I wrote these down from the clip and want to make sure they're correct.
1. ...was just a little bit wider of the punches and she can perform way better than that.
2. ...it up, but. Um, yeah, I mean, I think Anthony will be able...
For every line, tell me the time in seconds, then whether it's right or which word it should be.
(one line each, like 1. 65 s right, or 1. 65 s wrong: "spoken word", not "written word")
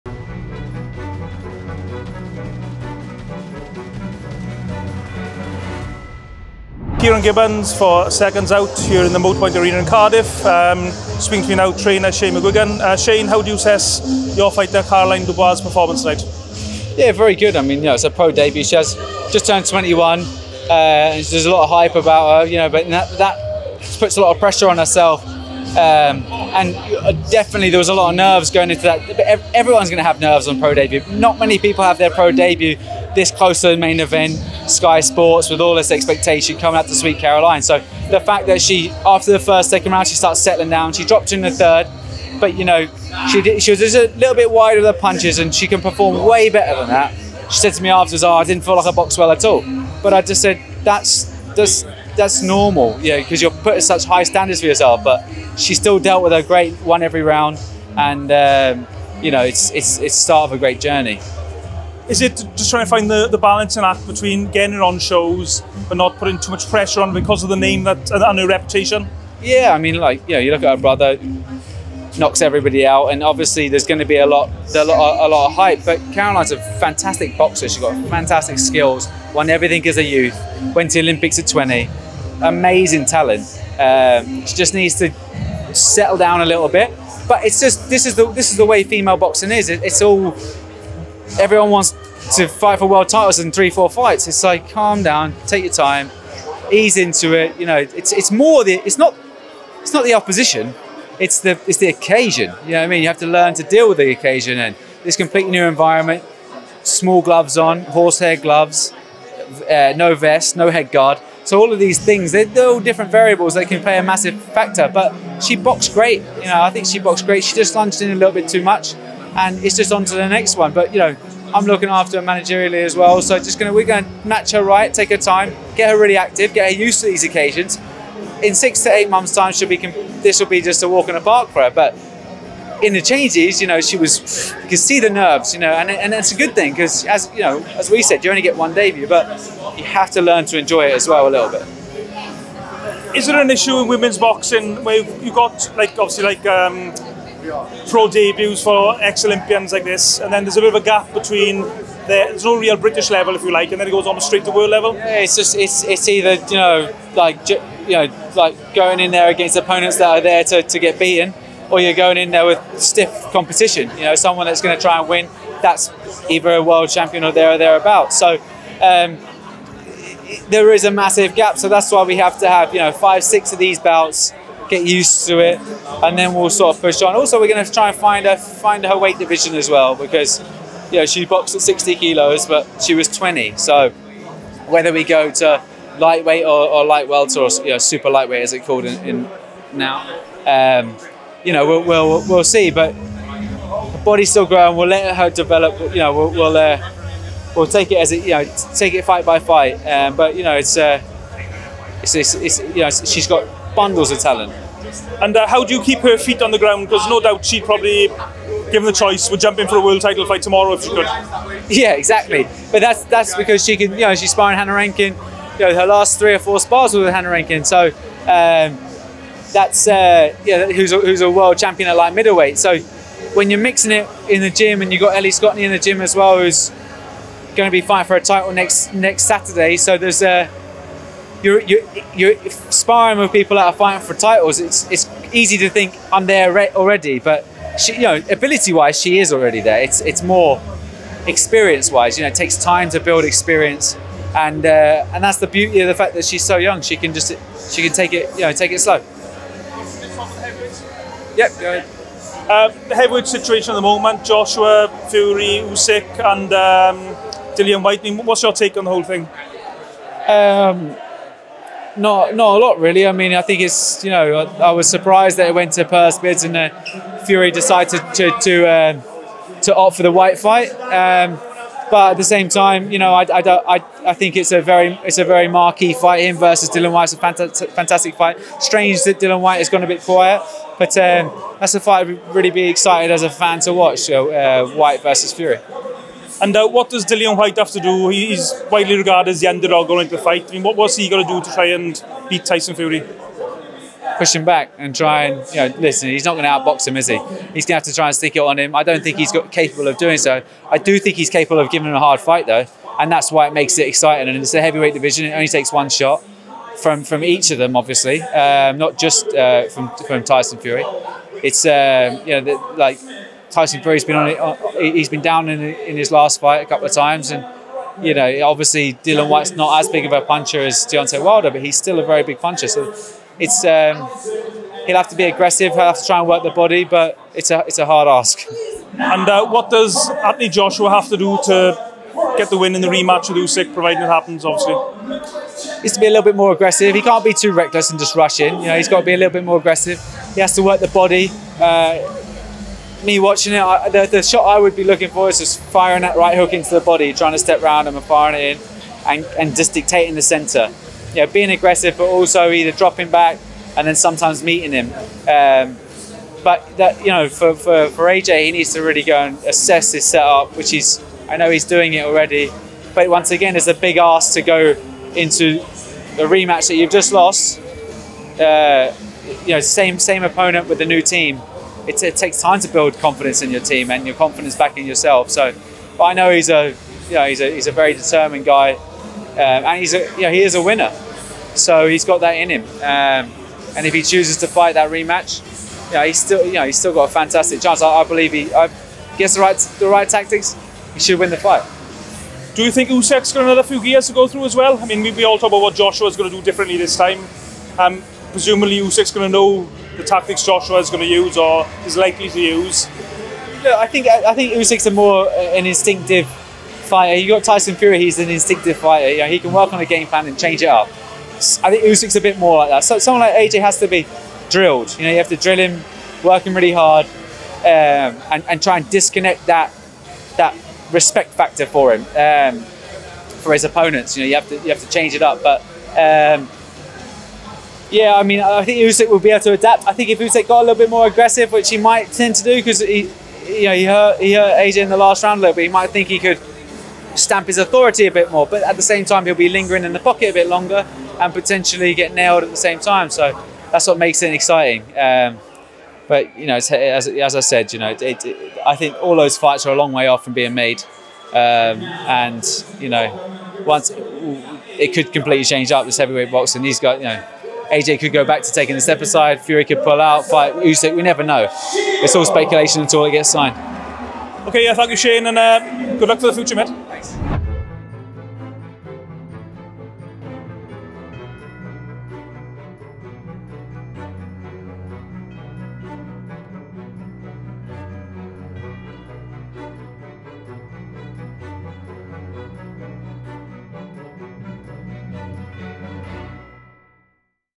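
1. 43 s right
2. 425 s wrong: "Usyk", not "Anthony".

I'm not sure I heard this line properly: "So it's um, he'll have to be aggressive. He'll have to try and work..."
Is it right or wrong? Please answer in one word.
right.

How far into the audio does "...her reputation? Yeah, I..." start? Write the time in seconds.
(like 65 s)
68 s.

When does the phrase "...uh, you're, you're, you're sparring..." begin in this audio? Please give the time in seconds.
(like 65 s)
230 s.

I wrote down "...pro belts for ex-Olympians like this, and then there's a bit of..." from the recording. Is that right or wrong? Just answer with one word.
wrong.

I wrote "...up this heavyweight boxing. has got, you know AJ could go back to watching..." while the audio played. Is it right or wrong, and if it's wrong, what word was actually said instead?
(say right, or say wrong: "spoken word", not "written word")
wrong: "taking", not "watching".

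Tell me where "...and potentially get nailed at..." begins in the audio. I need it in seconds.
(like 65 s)
441 s.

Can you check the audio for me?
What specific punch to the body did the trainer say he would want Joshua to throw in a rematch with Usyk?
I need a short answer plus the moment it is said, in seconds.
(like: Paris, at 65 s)
Right hook, at 346 s.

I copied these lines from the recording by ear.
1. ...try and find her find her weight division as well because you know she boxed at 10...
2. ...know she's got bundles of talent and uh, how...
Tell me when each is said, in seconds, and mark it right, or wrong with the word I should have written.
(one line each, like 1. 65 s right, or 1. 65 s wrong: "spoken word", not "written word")
1. 177 s wrong: "60", not "10"
2. 202 s right.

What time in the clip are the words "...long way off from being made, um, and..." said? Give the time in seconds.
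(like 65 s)
449 s.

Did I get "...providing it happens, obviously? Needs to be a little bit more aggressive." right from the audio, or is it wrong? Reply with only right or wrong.
right.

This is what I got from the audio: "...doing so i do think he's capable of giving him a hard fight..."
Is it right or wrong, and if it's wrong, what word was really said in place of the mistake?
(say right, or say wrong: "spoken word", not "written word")
right.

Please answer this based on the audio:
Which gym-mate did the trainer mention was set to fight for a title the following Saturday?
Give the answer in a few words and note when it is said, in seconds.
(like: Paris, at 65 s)
Ellie Scotney, at 225 s.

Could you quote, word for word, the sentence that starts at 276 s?
Him versus Dillian Whyte's a fantastic, fantastic fight.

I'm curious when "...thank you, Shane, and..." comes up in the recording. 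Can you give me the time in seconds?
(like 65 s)
464 s.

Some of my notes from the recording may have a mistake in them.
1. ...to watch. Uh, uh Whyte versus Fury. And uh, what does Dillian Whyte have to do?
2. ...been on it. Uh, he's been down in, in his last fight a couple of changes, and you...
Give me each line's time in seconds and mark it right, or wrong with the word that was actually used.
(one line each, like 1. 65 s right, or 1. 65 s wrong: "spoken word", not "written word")
1. 283 s right
2. 314 s wrong: "times", not "changes".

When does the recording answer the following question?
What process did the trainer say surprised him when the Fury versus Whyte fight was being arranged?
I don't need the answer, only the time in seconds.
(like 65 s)
265 s.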